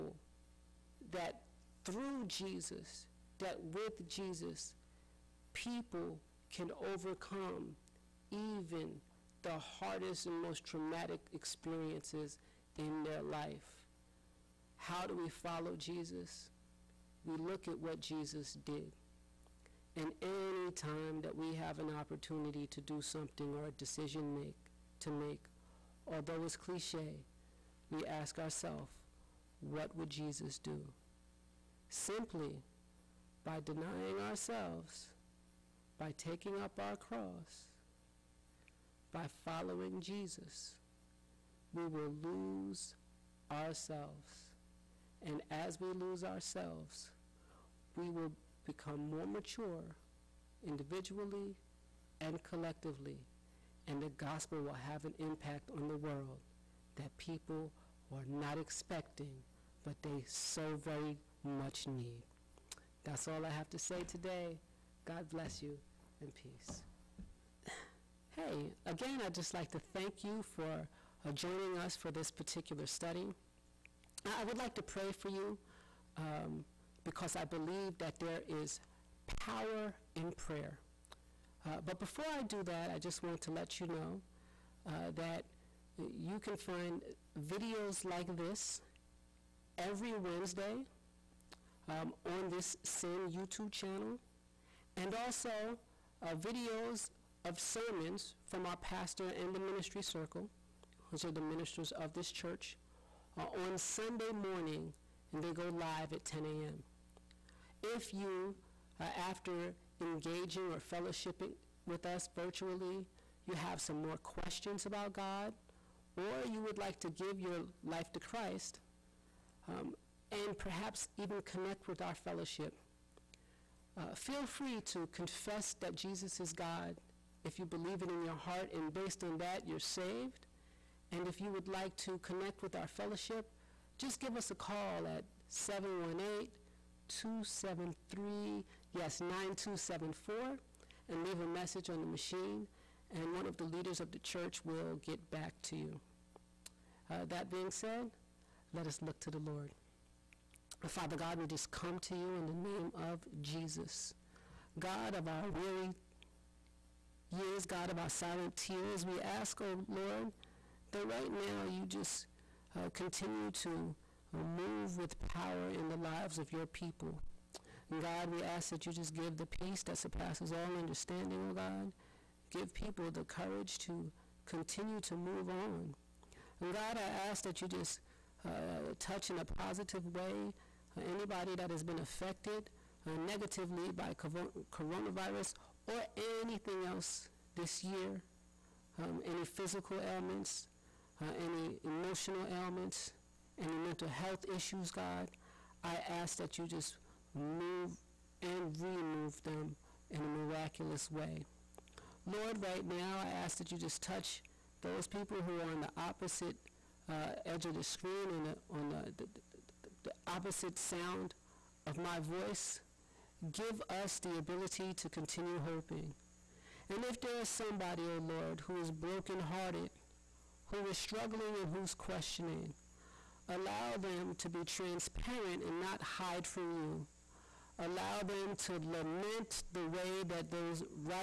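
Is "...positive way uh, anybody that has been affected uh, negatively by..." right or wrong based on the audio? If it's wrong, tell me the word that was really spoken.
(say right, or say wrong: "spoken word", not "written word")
right.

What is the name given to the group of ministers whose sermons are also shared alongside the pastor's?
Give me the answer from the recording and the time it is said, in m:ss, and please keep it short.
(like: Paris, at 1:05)
Ministry circle, at 1:39.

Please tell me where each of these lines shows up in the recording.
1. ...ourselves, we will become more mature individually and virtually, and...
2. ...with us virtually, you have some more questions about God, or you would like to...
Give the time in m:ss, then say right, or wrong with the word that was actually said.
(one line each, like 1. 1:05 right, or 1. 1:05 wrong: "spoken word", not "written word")
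1. 0:46 wrong: "collectively", not "virtually"
2. 1:51 right.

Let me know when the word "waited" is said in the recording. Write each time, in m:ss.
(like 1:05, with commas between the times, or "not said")
not said.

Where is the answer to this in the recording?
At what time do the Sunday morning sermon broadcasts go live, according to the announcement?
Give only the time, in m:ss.
1:46.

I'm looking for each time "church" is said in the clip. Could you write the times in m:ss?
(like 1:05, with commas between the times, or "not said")
1:42, 2:24.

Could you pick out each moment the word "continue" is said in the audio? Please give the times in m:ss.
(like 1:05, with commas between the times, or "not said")
2:42, 2:54, 3:35.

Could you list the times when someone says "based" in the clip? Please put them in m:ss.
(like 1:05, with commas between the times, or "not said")
2:08.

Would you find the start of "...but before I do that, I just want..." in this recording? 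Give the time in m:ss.
1:21.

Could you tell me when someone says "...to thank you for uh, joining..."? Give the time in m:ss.
1:09.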